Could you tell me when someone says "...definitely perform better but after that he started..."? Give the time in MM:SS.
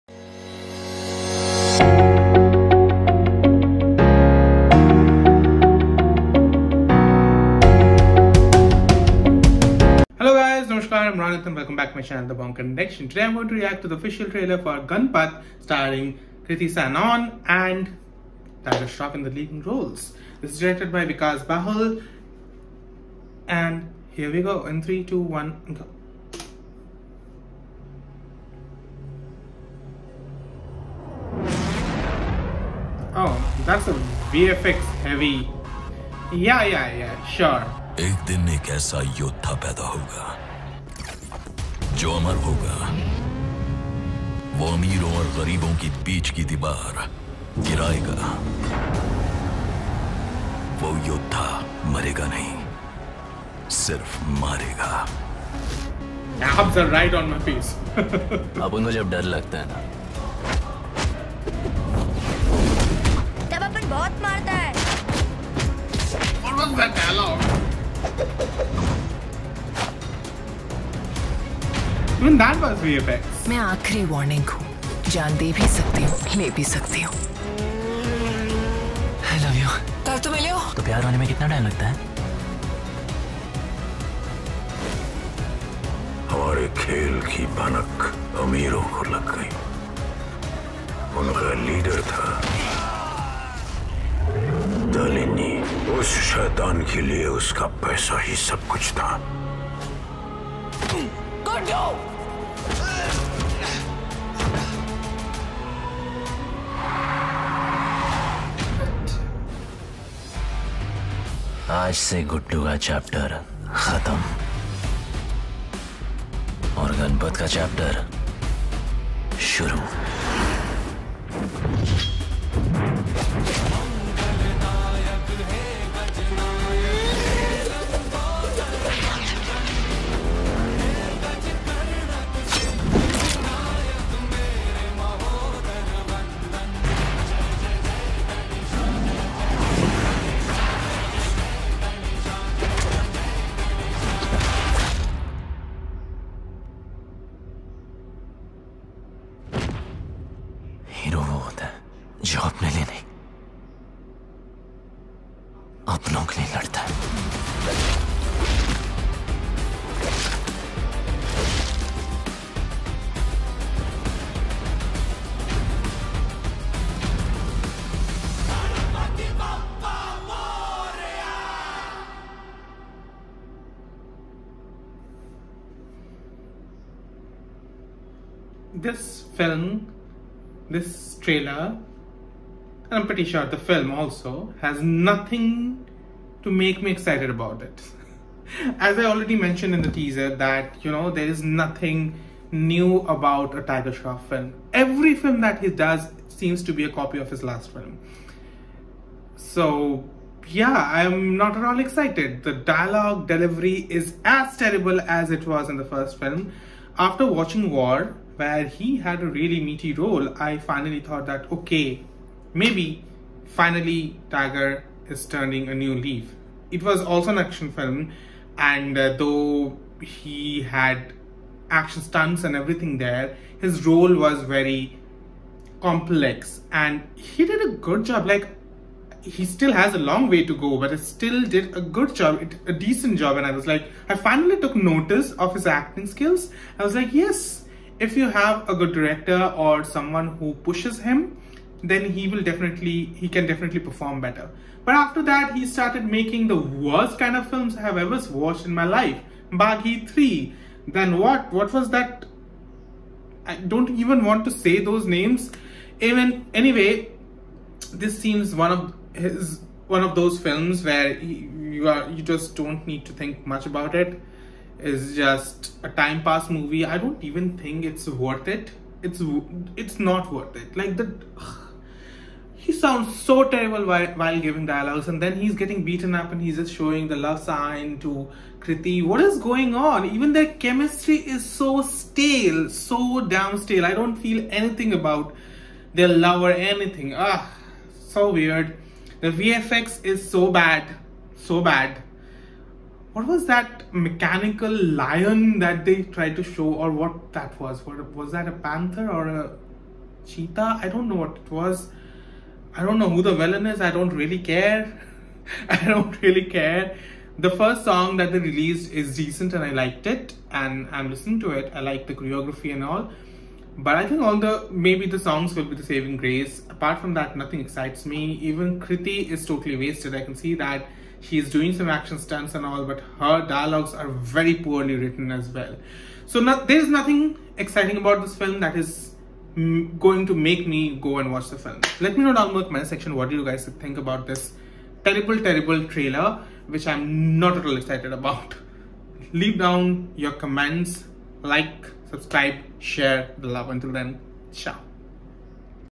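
04:03.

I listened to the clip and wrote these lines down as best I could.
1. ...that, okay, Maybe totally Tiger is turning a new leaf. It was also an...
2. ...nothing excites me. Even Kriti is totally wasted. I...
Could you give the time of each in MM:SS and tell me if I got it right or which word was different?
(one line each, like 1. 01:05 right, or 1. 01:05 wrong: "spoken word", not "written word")
1. 03:31 wrong: "finally", not "totally"
2. 05:17 right.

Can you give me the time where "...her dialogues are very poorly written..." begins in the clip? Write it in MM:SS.
05:23.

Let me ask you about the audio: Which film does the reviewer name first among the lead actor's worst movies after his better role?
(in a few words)
Baaghi 3.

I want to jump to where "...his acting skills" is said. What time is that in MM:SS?
03:55.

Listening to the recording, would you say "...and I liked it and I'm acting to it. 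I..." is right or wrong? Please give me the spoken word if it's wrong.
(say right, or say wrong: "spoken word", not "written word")
wrong: "listening", not "acting".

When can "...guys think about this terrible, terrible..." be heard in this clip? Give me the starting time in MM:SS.
05:33.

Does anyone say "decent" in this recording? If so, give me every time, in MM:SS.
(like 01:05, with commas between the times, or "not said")
03:52, 05:09.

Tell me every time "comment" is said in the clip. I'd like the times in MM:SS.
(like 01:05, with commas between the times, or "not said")
05:32, 05:40.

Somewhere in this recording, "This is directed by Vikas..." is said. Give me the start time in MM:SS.
00:20.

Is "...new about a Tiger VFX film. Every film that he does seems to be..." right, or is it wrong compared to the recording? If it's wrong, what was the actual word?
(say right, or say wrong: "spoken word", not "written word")
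wrong: "Shroff", not "VFX".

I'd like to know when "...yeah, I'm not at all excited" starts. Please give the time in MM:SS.
03:20.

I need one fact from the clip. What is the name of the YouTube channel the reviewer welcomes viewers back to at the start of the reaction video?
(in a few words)
The Bong Connection.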